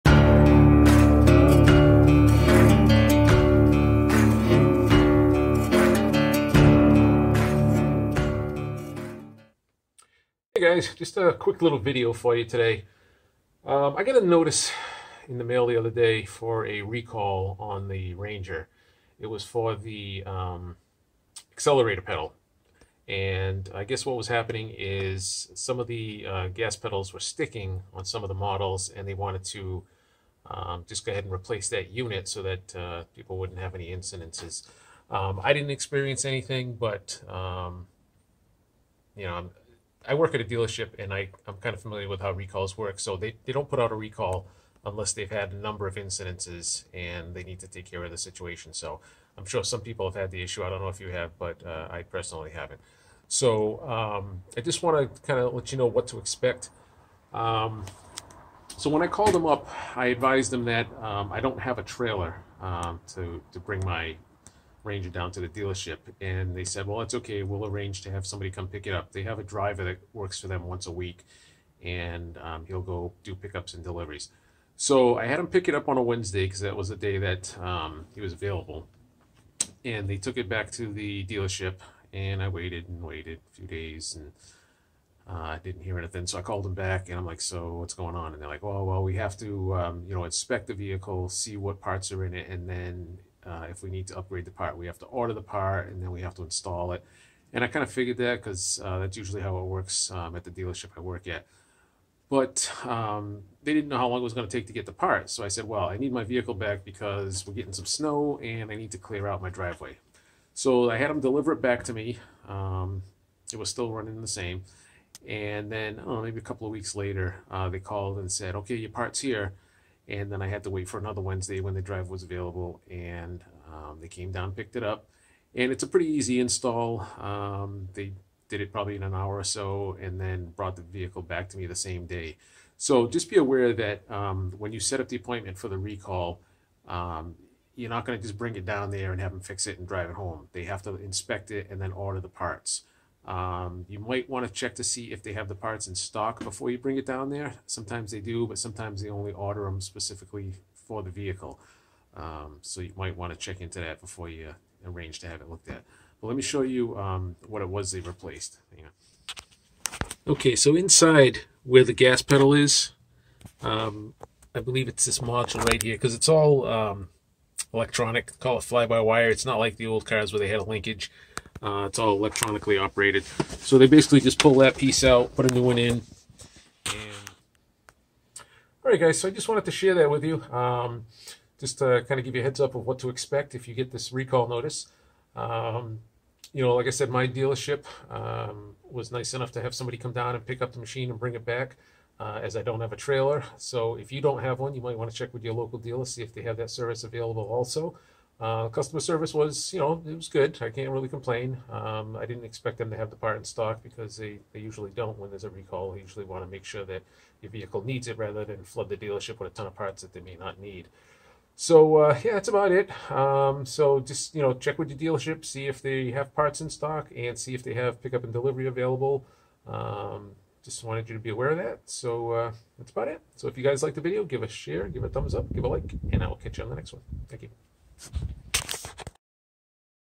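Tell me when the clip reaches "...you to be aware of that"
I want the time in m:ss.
3:41.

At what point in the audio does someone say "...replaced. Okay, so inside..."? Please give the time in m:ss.
2:37.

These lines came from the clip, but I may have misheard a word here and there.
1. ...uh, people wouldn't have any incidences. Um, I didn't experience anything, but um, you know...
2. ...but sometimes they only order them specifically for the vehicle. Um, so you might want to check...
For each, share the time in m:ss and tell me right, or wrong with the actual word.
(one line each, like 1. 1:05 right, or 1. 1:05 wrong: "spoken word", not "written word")
1. 0:32 right
2. 2:28 right.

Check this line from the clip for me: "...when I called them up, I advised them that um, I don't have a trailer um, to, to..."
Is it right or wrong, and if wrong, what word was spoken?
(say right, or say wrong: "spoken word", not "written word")
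right.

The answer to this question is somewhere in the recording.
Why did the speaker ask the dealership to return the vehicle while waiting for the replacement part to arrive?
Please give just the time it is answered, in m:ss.
1:47.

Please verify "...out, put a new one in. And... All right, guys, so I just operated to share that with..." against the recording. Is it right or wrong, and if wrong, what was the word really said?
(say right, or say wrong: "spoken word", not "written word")
wrong: "wanted", not "operated".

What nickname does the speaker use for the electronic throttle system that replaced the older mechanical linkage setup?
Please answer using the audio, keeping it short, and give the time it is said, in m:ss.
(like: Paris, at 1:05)
Fly-by-wire, at 2:48.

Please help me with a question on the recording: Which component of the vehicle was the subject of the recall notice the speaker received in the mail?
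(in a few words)
Accelerator pedal.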